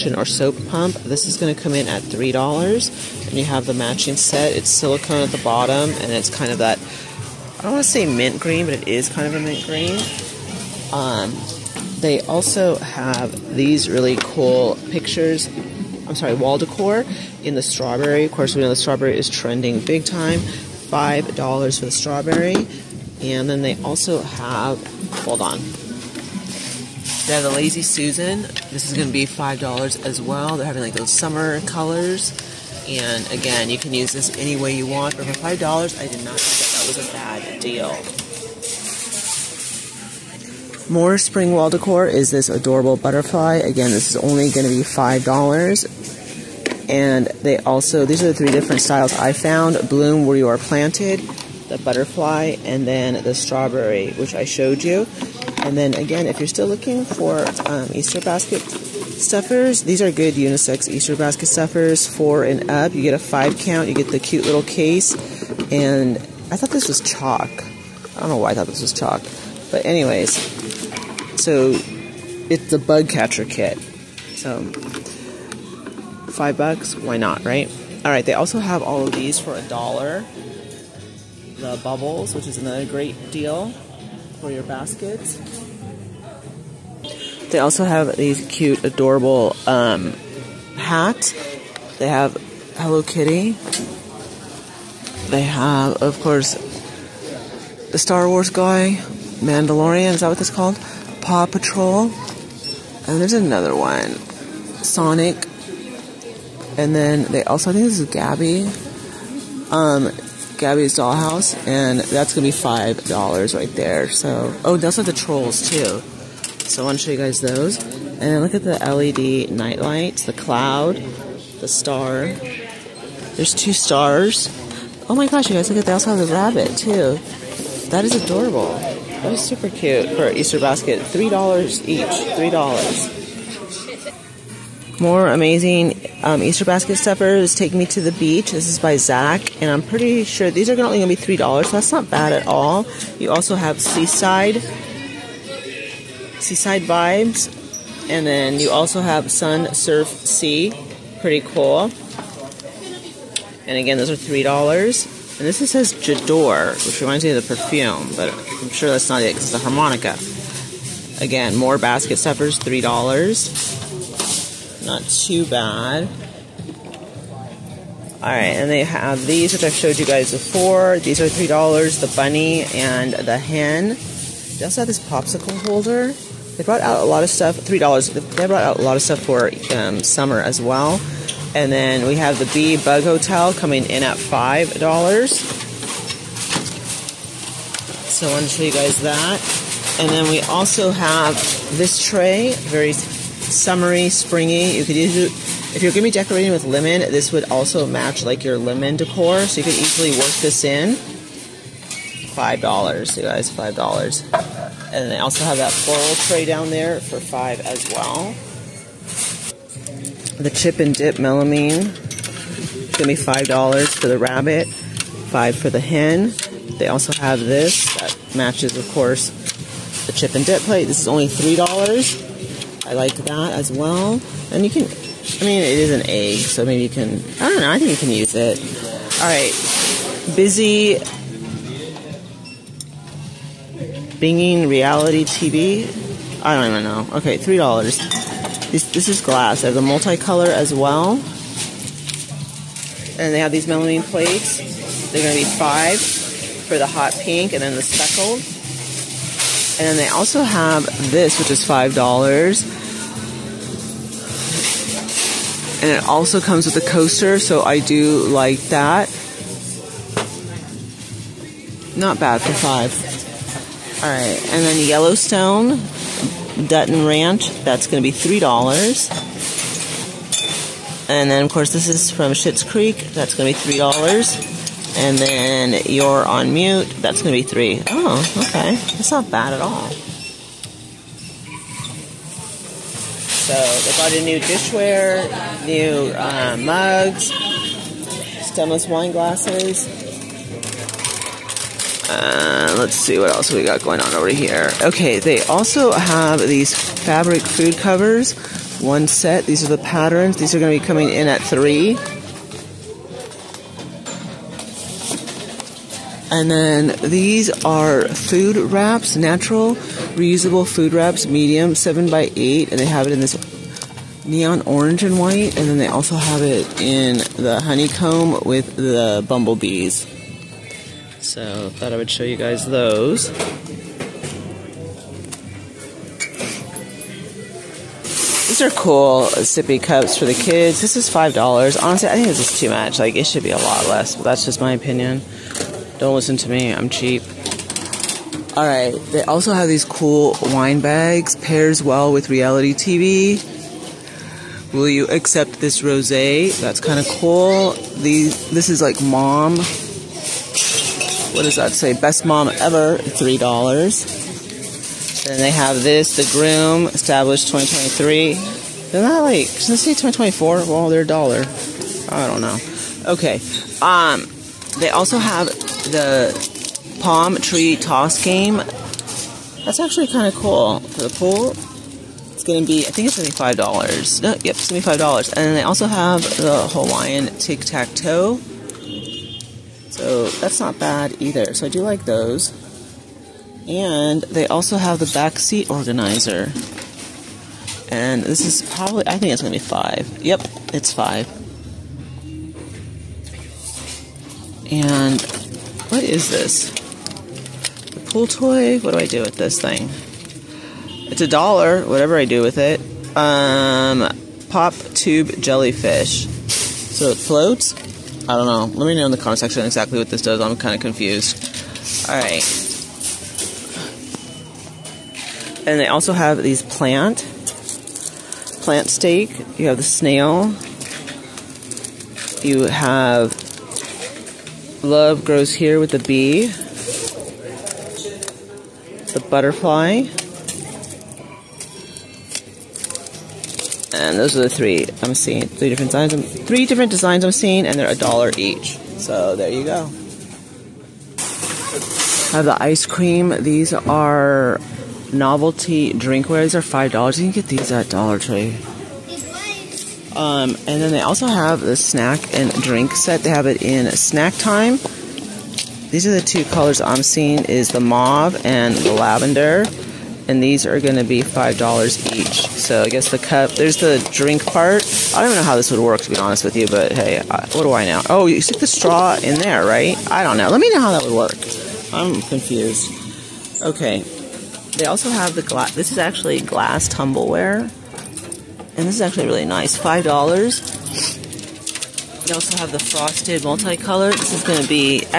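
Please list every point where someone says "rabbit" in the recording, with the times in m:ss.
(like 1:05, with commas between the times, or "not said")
2:06, 3:34.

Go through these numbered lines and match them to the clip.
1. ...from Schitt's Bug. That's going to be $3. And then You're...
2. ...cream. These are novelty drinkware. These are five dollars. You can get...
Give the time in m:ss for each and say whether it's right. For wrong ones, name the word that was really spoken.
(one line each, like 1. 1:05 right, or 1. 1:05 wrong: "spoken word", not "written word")
1. 4:32 wrong: "Creek", not "Bug"
2. 7:22 right.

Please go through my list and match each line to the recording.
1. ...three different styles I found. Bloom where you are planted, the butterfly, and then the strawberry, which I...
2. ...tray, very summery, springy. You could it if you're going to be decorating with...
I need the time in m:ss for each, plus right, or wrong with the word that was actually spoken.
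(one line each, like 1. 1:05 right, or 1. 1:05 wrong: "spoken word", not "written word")
1. 0:48 right
2. 3:12 right.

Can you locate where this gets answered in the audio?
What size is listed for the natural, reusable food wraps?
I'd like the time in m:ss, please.
5:11.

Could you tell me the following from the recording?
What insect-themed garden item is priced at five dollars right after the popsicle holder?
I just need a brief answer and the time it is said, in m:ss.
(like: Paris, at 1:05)
Bee Bug Hotel, at 3:02.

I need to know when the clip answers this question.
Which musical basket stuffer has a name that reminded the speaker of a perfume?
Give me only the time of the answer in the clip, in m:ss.
2:39.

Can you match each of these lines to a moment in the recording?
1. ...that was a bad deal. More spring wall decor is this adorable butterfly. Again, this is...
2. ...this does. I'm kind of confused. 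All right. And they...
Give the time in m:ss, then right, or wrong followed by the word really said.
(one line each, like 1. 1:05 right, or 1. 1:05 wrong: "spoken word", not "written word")
1. 0:36 right
2. 6:50 right.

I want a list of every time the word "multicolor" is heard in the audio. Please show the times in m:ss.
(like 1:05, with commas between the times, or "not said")
3:59, 8:03.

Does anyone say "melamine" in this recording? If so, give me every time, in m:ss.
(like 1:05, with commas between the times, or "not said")
3:31, 4:03.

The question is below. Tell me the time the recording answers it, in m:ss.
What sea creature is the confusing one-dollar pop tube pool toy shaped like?
6:45.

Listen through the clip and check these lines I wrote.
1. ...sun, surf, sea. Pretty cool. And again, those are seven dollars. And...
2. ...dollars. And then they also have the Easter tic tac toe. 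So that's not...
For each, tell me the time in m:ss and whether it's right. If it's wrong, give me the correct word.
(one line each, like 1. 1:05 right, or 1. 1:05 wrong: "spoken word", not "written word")
1. 2:29 wrong: "three", not "seven"
2. 6:14 wrong: "Hawaiian", not "Easter".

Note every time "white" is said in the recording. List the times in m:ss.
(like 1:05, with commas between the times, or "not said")
5:15.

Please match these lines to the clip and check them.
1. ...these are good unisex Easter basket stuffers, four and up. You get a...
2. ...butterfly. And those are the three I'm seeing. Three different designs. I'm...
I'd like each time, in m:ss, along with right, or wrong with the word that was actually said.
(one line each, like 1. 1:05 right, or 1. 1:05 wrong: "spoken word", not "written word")
1. 0:59 right
2. 7:09 right.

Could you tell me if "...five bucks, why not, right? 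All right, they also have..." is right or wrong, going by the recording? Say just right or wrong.
right.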